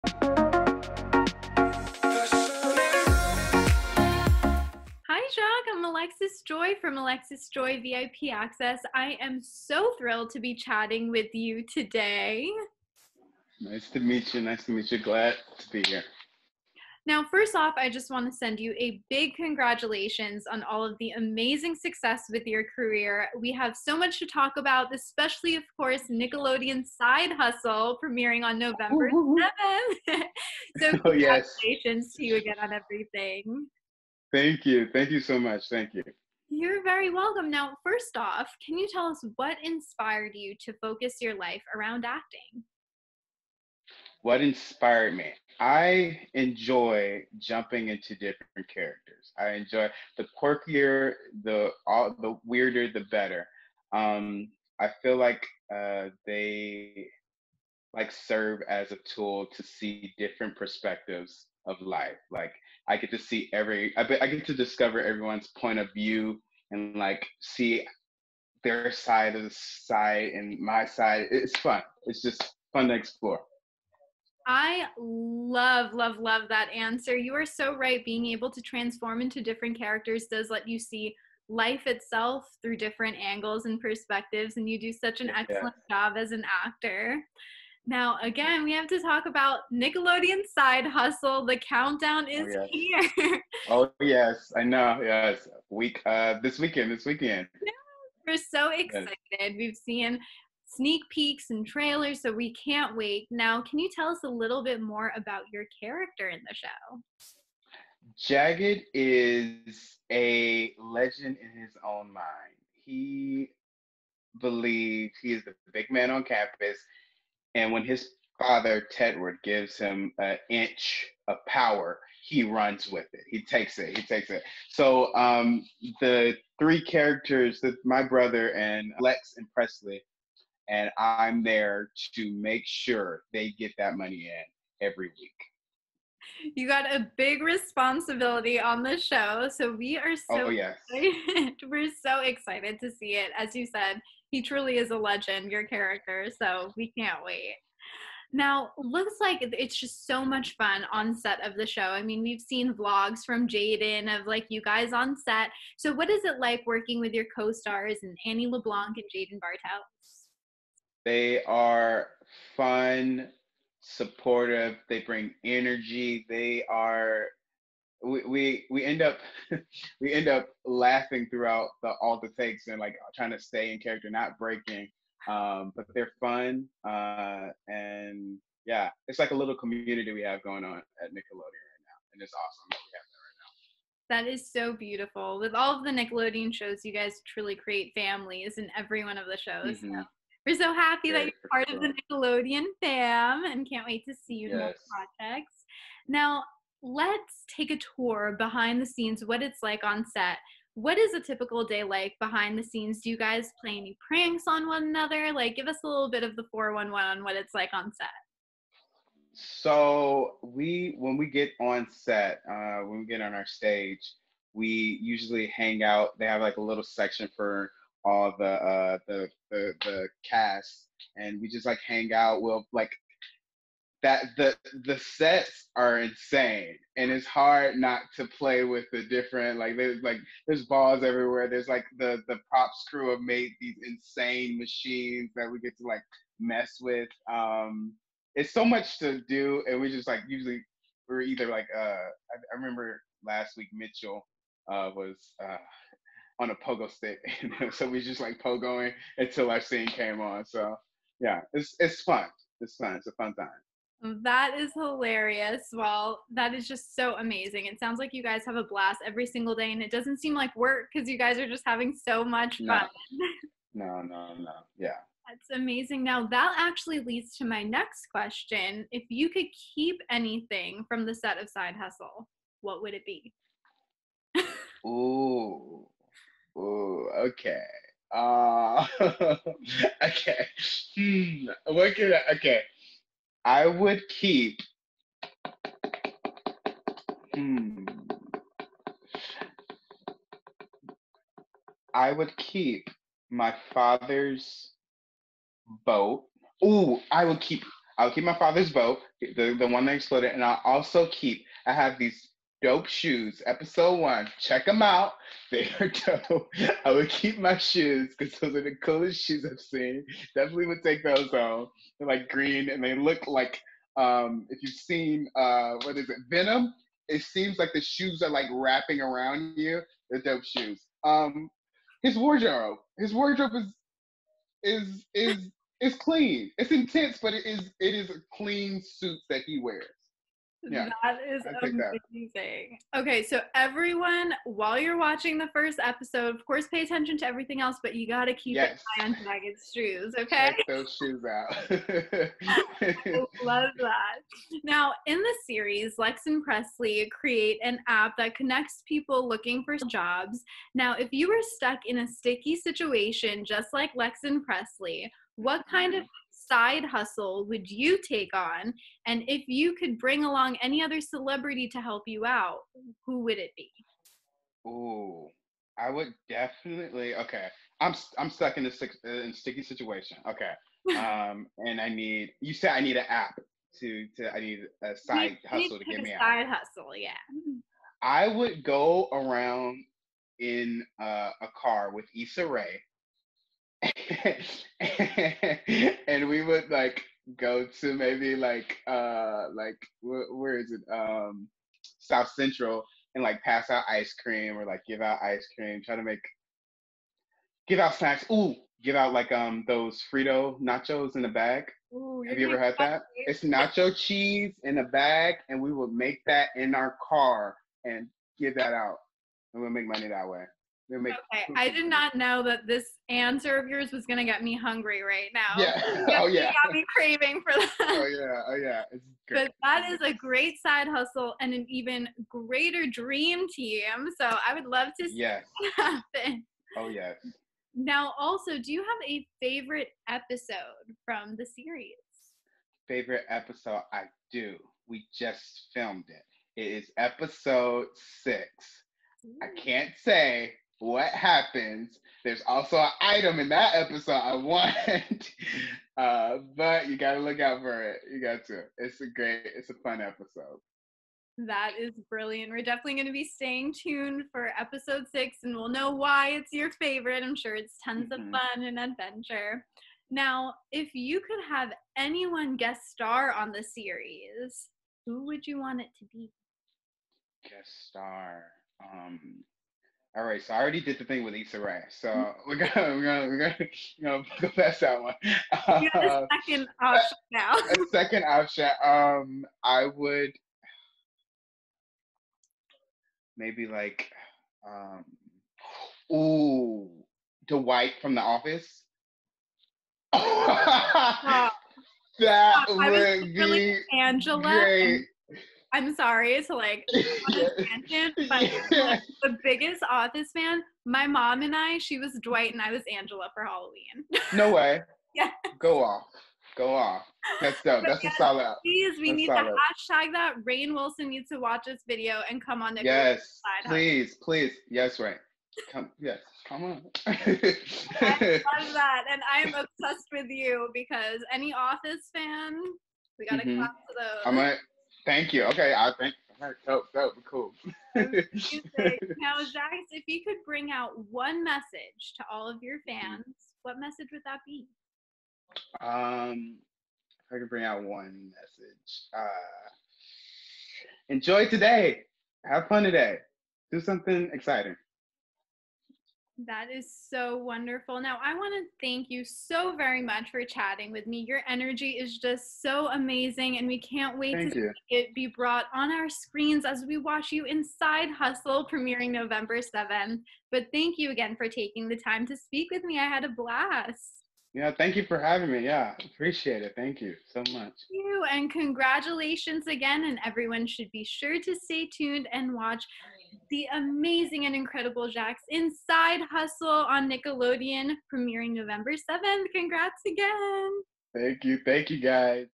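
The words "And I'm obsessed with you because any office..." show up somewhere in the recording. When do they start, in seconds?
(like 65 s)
519 s.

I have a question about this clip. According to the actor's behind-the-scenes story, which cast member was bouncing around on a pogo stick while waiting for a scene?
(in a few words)
Mitchell.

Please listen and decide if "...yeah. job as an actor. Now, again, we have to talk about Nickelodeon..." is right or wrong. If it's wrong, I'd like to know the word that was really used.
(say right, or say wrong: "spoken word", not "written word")
right.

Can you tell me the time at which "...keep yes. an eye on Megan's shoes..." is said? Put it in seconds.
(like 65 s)
338 s.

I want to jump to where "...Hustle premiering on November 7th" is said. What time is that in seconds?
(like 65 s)
27 s.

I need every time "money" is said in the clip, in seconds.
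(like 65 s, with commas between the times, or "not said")
133 s, 409 s.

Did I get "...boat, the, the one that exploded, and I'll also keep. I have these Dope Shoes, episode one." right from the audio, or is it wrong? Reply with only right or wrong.
right.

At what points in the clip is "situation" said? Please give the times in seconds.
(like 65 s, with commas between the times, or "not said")
352 s, 369 s.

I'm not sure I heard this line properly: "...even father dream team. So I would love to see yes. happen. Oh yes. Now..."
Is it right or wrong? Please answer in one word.
wrong.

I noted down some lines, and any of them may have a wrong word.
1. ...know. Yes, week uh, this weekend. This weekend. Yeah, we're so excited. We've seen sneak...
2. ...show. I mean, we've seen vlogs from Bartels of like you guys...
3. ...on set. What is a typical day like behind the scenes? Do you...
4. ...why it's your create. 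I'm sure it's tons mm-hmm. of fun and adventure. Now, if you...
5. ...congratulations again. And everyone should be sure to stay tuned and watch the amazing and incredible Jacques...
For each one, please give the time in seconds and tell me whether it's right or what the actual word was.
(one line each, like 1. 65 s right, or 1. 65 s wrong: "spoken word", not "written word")
1. 94 s right
2. 151 s wrong: "Jayden", not "Bartels"
3. 199 s right
4. 455 s wrong: "favorite", not "create"
5. 568 s right.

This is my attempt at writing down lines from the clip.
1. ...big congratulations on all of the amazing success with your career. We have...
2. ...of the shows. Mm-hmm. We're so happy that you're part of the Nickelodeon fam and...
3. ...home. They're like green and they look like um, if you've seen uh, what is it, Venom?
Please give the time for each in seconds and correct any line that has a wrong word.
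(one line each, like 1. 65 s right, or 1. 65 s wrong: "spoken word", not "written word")
1. 19 s right
2. 189 s right
3. 311 s right.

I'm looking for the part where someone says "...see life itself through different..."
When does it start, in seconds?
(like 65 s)
80 s.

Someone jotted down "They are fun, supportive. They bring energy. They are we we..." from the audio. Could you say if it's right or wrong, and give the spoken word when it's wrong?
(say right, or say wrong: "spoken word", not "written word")
right.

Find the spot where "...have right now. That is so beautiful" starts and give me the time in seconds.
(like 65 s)
184 s.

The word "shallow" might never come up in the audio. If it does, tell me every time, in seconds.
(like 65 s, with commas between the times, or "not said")
not said.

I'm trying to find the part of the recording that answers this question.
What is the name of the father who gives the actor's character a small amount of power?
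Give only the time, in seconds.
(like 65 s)
118 s.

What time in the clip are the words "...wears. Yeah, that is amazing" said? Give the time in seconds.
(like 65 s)
329 s.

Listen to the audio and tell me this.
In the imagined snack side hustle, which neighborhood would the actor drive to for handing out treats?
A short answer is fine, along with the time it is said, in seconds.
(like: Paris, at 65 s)
South Central, at 391 s.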